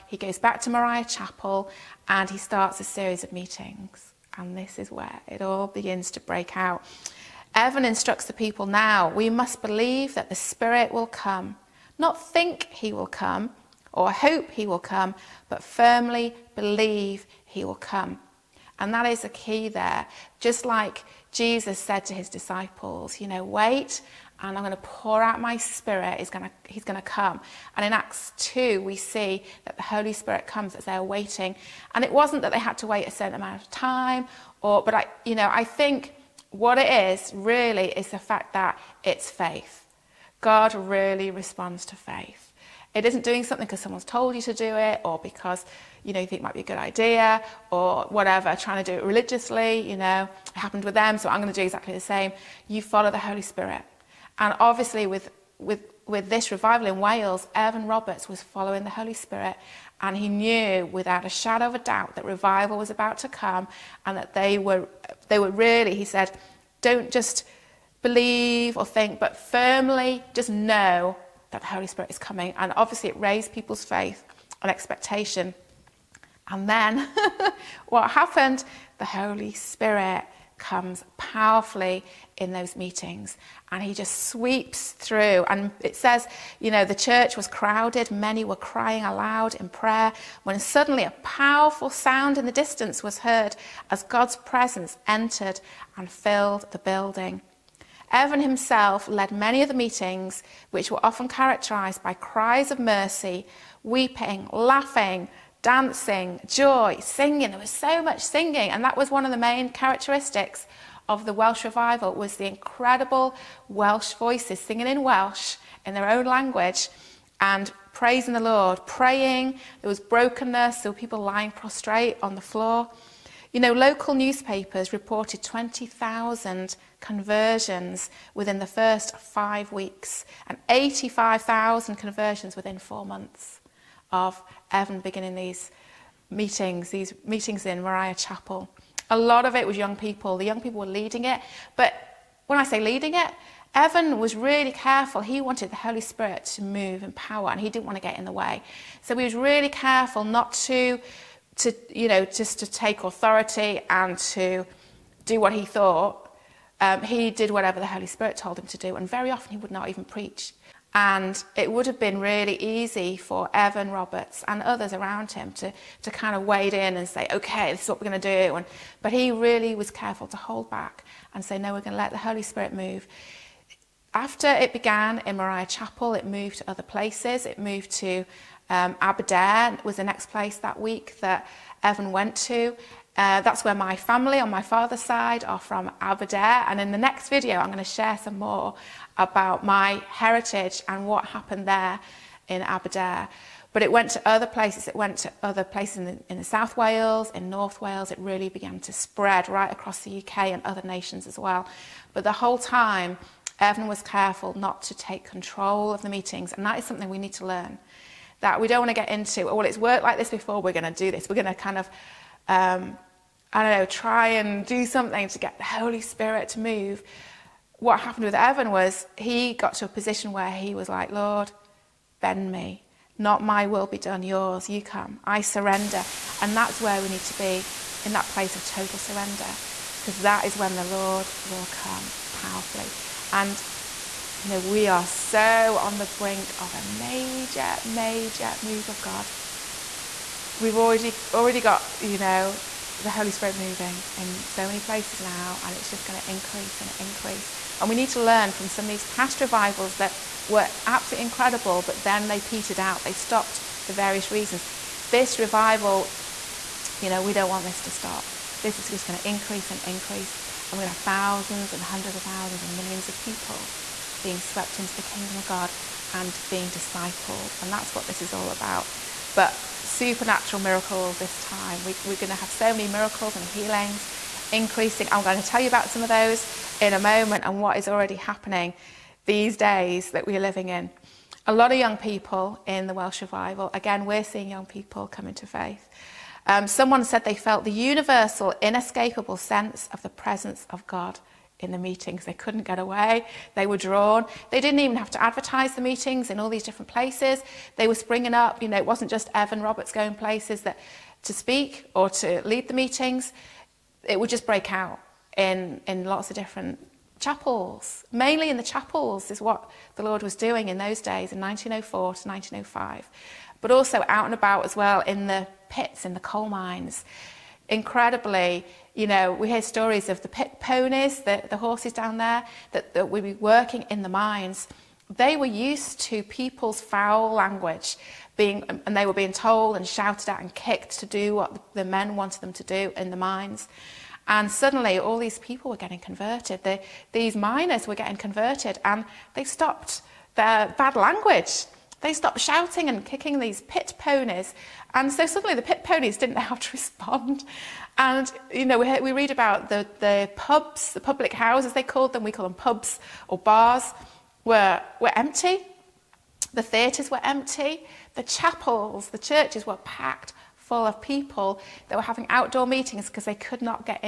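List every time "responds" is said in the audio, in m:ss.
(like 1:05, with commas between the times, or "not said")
0:41, 5:46.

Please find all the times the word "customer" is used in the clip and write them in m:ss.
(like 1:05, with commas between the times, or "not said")
not said.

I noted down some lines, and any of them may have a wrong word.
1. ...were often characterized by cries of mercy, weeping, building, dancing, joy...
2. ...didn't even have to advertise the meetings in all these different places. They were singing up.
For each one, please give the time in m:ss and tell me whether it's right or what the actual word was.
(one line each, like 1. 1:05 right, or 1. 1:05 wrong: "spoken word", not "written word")
1. 1:40 wrong: "laughing", not "building"
2. 4:54 wrong: "springing", not "singing".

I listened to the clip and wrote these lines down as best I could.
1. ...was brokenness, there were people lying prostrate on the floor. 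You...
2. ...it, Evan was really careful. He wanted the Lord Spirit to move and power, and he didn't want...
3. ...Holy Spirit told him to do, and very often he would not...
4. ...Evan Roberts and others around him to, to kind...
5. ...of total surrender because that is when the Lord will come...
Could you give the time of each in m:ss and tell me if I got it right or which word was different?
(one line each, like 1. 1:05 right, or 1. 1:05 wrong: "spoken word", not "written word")
1. 1:59 right
2. 2:23 wrong: "Holy", not "Lord"
3. 2:37 right
4. 2:43 right
5. 3:48 right.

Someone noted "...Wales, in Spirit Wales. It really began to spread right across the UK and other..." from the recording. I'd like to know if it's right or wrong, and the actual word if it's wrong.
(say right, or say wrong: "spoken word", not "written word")
wrong: "North", not "Spirit".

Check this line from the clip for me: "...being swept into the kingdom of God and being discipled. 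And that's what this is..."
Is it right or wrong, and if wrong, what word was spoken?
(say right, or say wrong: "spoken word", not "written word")
right.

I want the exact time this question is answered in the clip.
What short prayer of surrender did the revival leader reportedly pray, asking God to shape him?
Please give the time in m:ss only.
3:41.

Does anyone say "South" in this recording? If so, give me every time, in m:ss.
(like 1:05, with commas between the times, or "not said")
3:16.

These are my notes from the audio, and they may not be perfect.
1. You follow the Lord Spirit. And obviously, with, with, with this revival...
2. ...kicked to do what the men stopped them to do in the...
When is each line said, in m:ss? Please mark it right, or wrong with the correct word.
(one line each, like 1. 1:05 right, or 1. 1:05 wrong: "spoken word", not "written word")
1. 0:52 wrong: "Holy", not "Lord"
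2. 5:30 wrong: "wanted", not "stopped".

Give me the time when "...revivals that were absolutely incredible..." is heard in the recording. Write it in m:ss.
4:09.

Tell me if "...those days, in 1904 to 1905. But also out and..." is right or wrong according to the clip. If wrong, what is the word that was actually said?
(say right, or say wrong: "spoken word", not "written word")
right.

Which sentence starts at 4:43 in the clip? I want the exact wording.
Again, we're seeing young people come into faith.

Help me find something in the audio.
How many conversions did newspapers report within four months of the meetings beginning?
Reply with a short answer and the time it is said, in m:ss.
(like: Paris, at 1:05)
85,000, at 2:10.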